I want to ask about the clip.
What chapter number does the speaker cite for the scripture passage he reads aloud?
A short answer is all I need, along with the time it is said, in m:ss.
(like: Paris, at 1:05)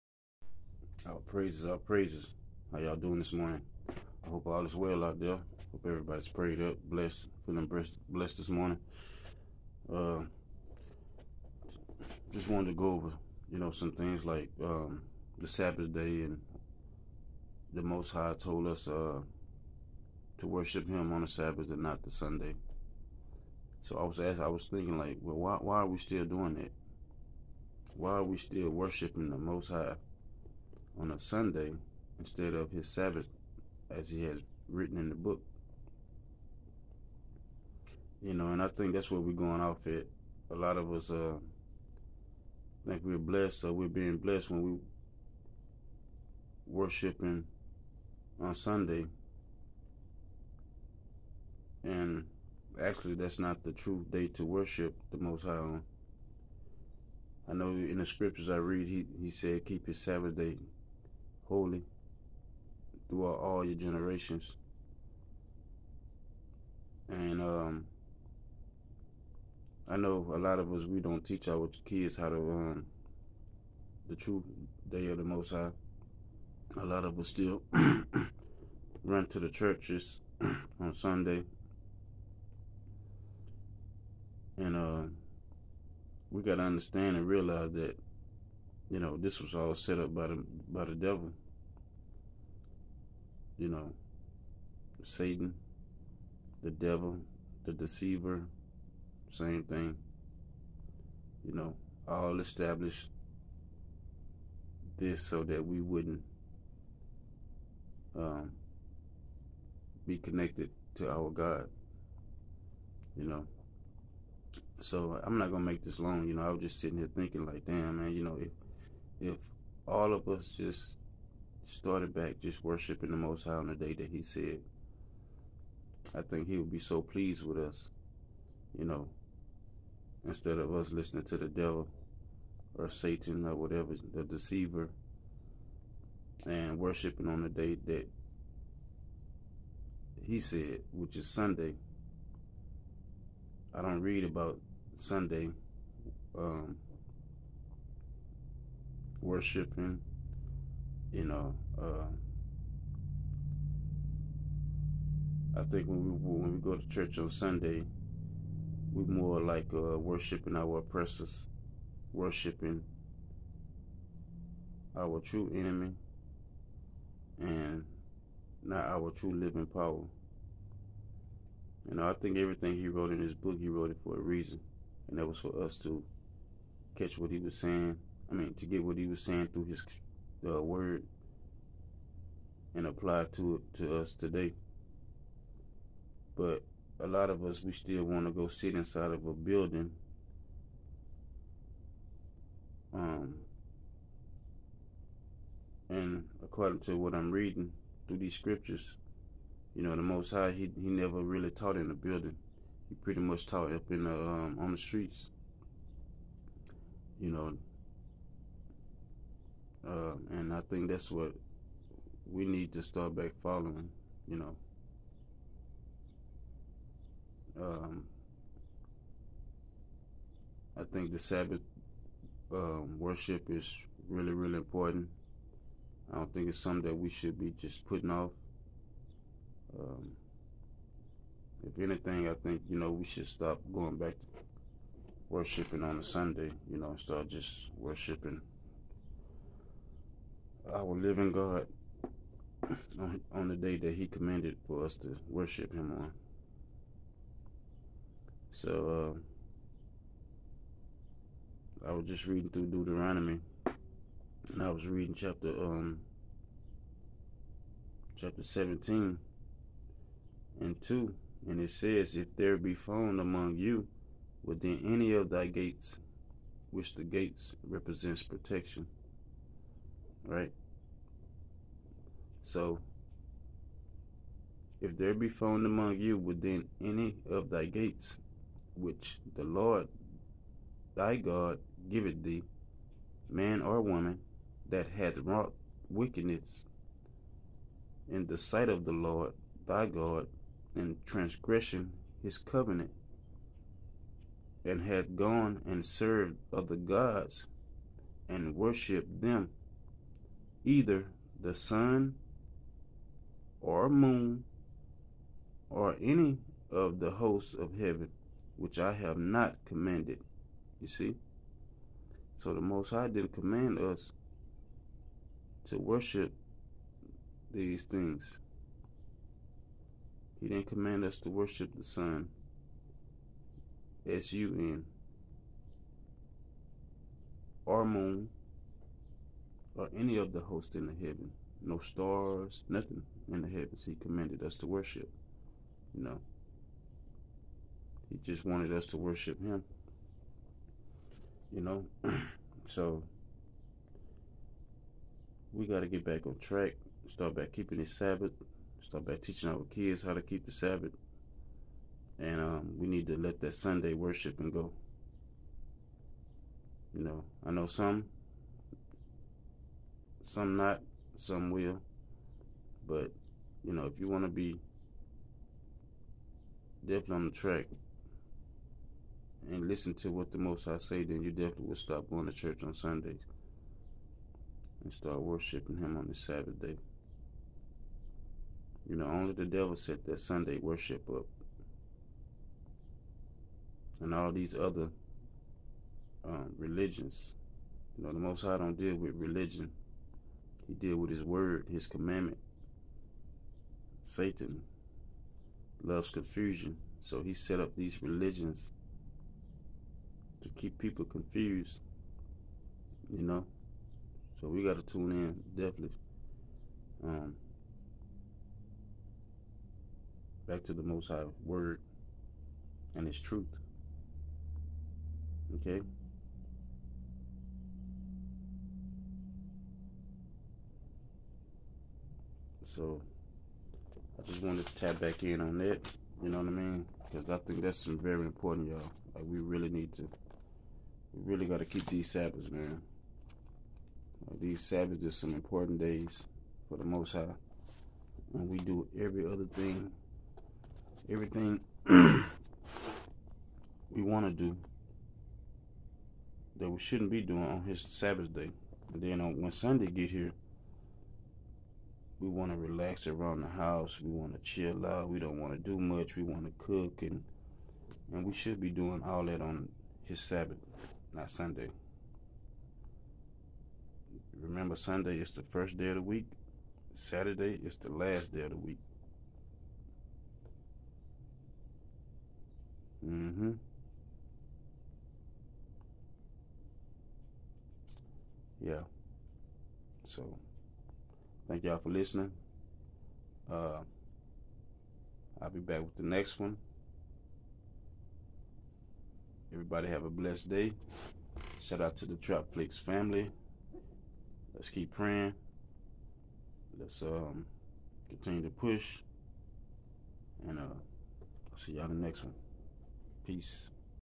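17, at 4:18.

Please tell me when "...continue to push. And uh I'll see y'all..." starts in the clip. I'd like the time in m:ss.
8:18.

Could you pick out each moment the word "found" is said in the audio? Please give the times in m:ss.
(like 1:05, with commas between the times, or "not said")
4:22, 4:35.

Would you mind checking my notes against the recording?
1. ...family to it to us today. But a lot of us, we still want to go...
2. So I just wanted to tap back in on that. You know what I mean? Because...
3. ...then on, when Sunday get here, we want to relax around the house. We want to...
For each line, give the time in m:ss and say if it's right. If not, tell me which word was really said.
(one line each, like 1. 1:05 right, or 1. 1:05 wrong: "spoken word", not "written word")
1. 3:02 wrong: "apply", not "family"
2. 7:02 right
3. 7:29 right.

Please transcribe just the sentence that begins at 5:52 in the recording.
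And um, we need to let that Sunday worshiping go.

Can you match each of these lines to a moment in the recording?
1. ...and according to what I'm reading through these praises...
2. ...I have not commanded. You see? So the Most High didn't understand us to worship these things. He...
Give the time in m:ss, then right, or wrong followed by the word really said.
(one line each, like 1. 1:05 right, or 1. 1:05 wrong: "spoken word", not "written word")
1. 3:15 wrong: "scriptures", not "praises"
2. 5:08 wrong: "command", not "understand".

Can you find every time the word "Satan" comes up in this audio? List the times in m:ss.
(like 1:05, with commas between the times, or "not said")
1:35, 2:12, 6:34.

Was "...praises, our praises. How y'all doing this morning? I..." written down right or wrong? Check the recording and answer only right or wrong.
right.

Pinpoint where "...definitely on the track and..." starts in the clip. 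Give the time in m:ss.
6:06.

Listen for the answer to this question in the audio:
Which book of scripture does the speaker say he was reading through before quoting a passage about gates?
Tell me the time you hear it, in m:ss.
4:12.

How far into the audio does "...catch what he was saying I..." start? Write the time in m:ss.
2:56.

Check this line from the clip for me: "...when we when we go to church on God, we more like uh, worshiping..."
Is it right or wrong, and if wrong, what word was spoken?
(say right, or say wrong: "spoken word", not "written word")
wrong: "Sunday", not "God".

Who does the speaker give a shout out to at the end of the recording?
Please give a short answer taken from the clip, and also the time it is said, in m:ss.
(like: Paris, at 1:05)
Trap Flix family, at 8:12.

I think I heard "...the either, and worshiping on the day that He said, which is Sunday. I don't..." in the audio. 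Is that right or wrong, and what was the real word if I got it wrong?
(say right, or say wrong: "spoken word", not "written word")
wrong: "deceiver", not "either".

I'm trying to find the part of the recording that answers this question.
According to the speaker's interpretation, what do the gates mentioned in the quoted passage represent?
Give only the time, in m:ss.
4:28.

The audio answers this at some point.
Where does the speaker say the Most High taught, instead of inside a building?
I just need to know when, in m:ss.
3:24.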